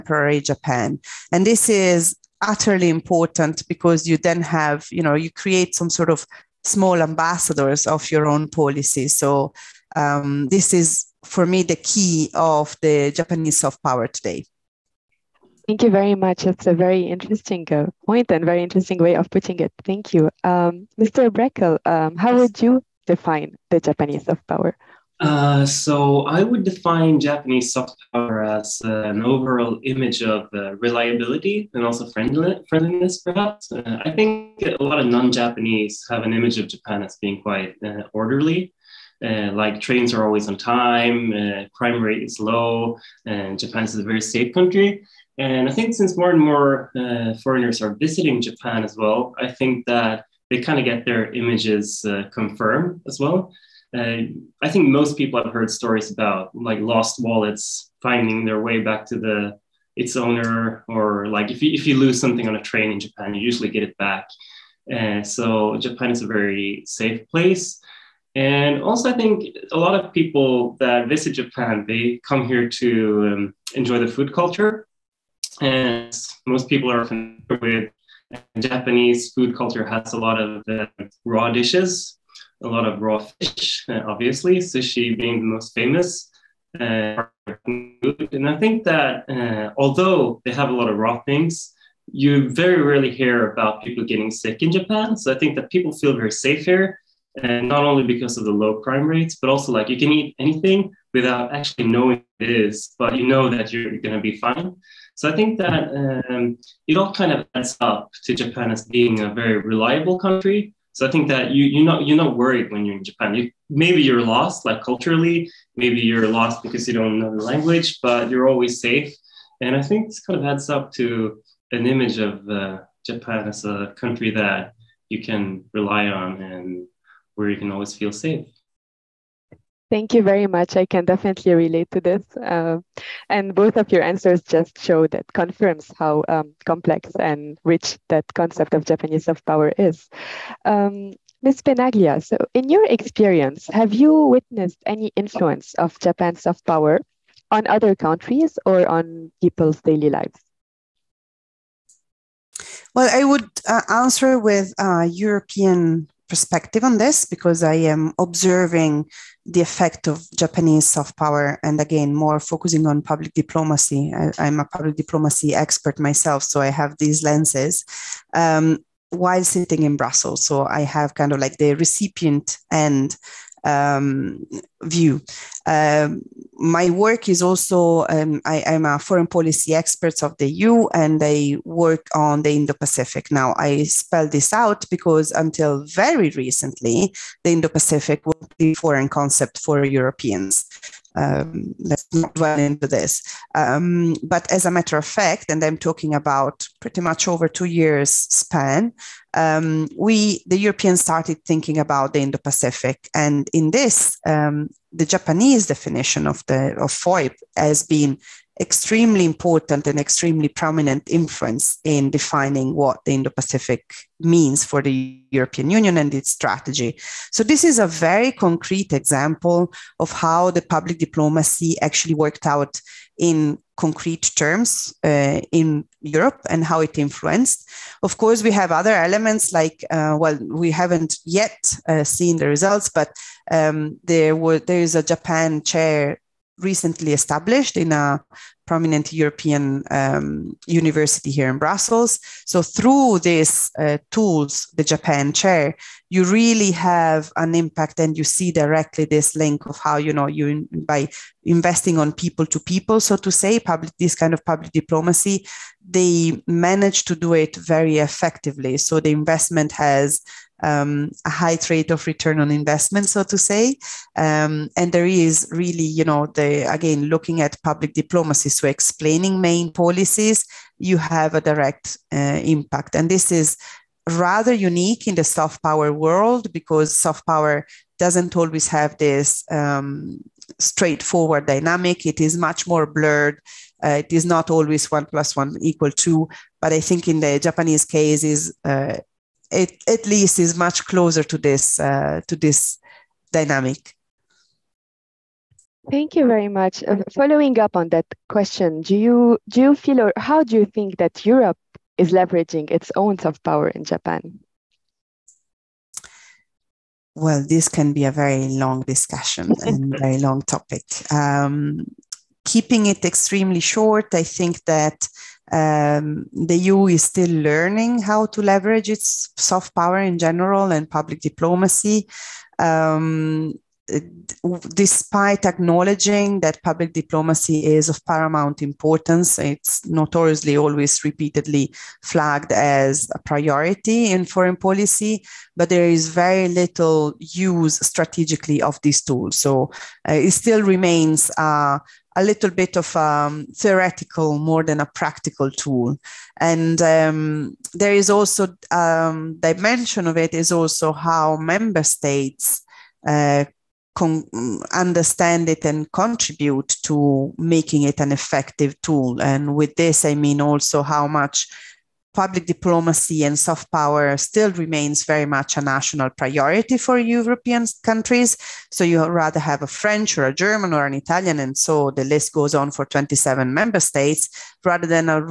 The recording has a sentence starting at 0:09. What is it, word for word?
So um, this is for me the key of the Japanese soft power today.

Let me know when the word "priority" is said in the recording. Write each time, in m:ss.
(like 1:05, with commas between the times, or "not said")
5:33, 6:06.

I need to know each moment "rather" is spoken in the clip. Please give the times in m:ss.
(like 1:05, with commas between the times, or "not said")
4:34, 6:09, 6:14.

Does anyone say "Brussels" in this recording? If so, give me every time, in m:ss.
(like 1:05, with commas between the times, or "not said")
2:49, 4:01.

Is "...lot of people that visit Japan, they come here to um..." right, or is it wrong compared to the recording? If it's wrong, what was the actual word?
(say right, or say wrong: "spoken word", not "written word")
right.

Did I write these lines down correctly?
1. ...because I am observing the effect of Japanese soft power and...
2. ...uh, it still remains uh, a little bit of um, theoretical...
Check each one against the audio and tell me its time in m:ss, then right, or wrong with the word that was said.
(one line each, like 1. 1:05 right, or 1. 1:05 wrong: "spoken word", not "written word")
1. 2:37 right
2. 5:40 right.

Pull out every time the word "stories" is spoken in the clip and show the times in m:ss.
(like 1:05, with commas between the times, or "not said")
0:55.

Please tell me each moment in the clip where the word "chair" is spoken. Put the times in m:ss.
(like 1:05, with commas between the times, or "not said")
3:55, 4:05.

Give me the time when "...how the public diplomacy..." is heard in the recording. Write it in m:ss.
3:40.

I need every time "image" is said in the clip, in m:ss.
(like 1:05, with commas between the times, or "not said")
0:29, 0:36, 0:51, 2:01.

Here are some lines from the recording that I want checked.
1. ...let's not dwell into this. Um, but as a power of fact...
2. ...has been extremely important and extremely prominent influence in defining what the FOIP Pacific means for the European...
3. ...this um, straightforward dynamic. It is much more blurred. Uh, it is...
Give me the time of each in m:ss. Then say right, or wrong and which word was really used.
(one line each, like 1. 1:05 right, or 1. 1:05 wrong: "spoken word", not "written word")
1. 3:11 wrong: "matter", not "power"
2. 3:27 wrong: "Indo", not "FOIP"
3. 4:38 right.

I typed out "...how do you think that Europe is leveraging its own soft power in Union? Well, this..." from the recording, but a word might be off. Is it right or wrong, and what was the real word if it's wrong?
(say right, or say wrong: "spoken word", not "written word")
wrong: "Japan", not "Union".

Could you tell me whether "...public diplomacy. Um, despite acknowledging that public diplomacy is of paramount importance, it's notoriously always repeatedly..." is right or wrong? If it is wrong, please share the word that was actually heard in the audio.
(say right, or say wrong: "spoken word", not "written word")
right.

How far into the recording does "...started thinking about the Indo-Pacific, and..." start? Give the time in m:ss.
3:21.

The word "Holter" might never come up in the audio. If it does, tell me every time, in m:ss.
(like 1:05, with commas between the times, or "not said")
not said.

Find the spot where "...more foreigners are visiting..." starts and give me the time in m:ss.
0:46.